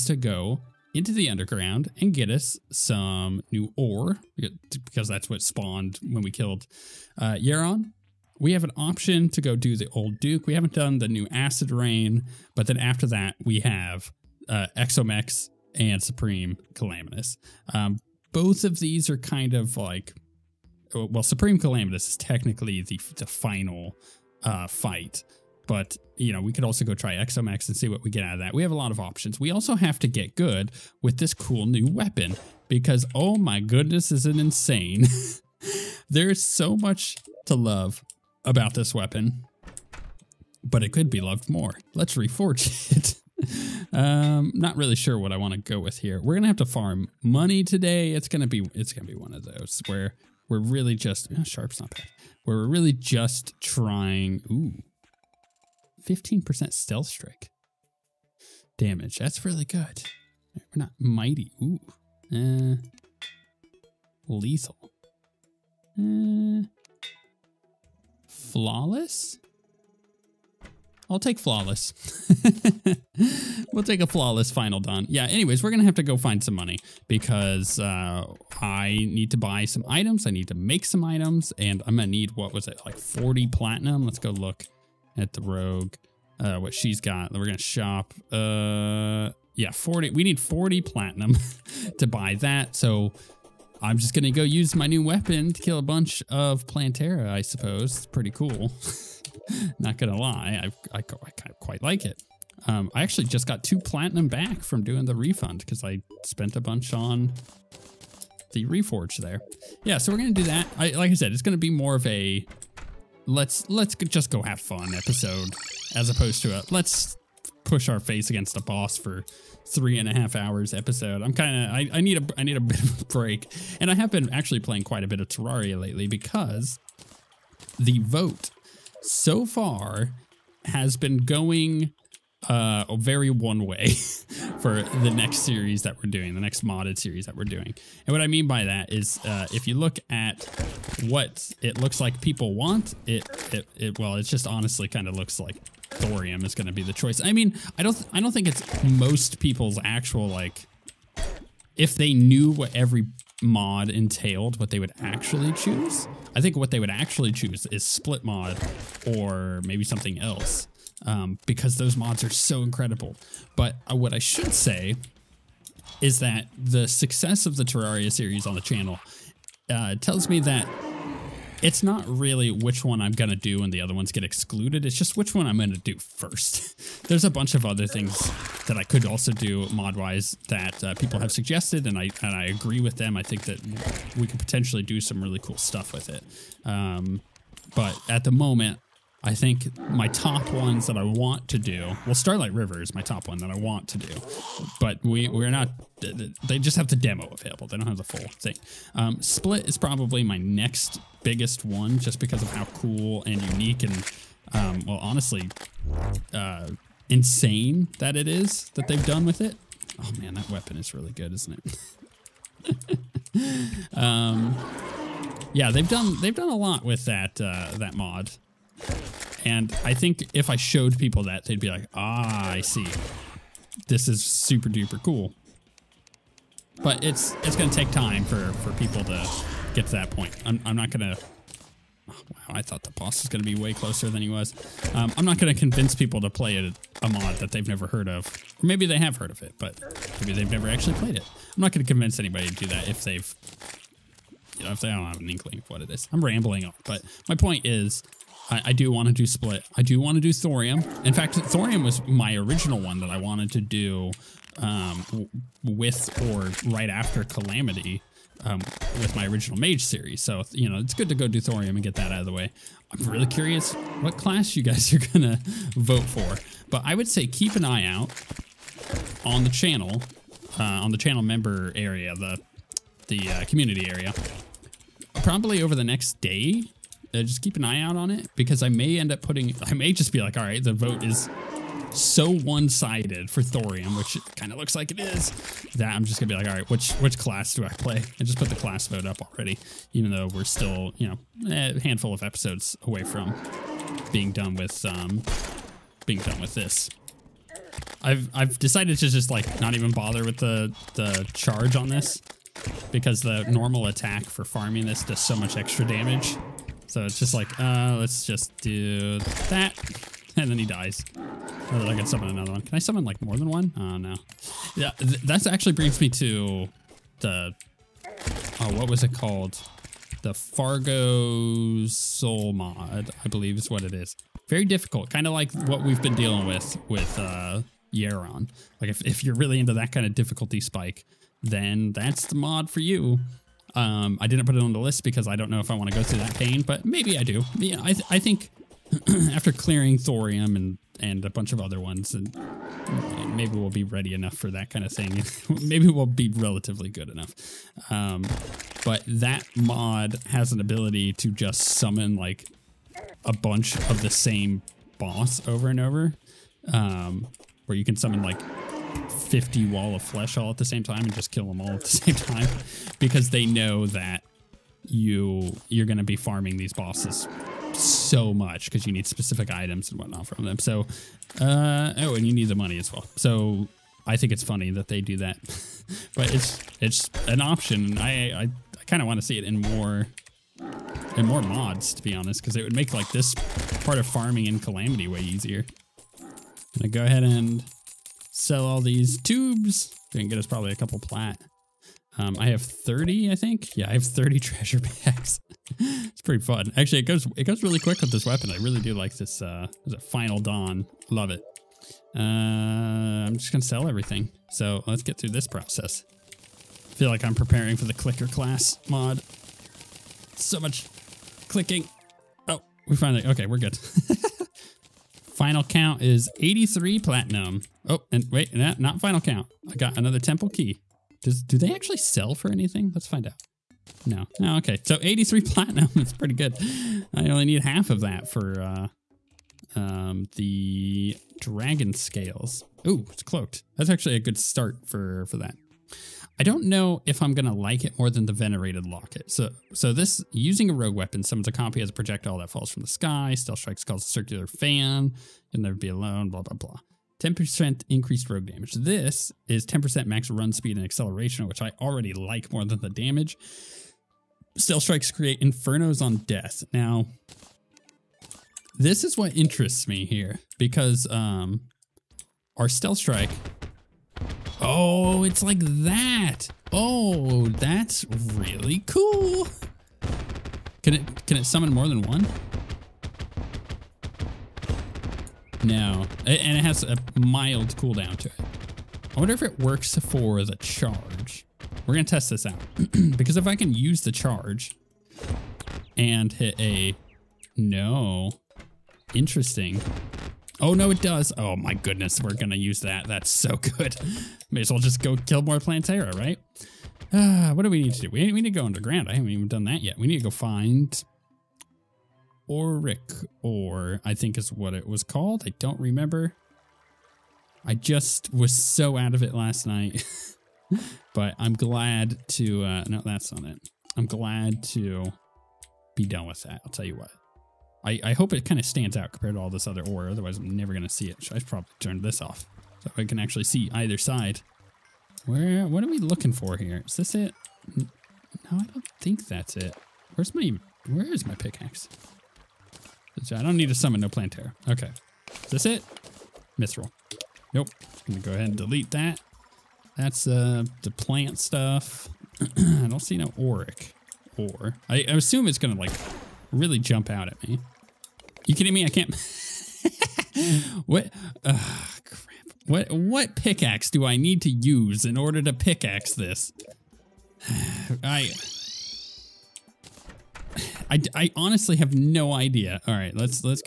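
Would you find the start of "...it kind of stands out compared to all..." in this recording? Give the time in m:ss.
8:38.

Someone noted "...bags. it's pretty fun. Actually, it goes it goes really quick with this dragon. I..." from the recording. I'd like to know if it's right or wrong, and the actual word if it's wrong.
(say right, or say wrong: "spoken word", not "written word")
wrong: "weapon", not "dragon".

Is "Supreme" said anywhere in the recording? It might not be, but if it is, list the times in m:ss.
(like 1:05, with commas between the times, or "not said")
0:16, 0:21.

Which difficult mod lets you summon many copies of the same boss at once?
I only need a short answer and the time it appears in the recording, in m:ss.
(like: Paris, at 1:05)
Fargo Soul mod, at 5:20.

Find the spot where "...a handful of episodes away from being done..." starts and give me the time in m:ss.
4:51.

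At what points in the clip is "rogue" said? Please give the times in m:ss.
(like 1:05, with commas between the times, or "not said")
1:25, 7:20, 7:28.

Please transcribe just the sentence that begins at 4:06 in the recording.
I'm rambling on, but my point is I, I do want to do Split.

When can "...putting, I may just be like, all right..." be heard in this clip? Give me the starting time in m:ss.
4:39.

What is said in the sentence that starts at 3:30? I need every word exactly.
Oh man, that weapon is really good, isn't it?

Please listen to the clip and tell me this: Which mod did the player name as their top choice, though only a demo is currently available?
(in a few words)
Starlight River.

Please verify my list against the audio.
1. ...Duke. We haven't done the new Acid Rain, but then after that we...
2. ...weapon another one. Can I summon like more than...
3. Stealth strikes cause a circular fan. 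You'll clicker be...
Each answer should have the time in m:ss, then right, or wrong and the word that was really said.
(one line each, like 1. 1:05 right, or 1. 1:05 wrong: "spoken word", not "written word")
1. 0:10 right
2. 5:12 wrong: "summon", not "weapon"
3. 7:23 wrong: "never", not "clicker".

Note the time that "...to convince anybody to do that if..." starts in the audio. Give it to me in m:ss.
4:01.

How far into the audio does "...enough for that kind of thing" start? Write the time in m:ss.
5:44.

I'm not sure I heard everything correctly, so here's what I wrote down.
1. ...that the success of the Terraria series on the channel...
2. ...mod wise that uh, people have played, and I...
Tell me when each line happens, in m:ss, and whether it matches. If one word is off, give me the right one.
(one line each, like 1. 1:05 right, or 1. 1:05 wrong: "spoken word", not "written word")
1. 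2:46 right
2. 2:59 wrong: "suggested", not "played".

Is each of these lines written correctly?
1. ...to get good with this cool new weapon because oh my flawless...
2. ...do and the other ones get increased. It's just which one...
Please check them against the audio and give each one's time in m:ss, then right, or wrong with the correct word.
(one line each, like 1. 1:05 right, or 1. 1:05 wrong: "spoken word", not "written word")
1. 0:30 wrong: "goodness", not "flawless"
2. 2:53 wrong: "excluded", not "increased".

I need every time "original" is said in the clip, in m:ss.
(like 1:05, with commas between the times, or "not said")
4:12, 4:19.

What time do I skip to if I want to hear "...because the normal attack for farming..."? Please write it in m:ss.
5:02.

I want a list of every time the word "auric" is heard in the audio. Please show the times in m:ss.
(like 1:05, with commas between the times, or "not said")
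8:22, 9:03.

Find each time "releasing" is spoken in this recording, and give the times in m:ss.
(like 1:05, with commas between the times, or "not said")
not said.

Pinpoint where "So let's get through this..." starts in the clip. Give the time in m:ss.
6:44.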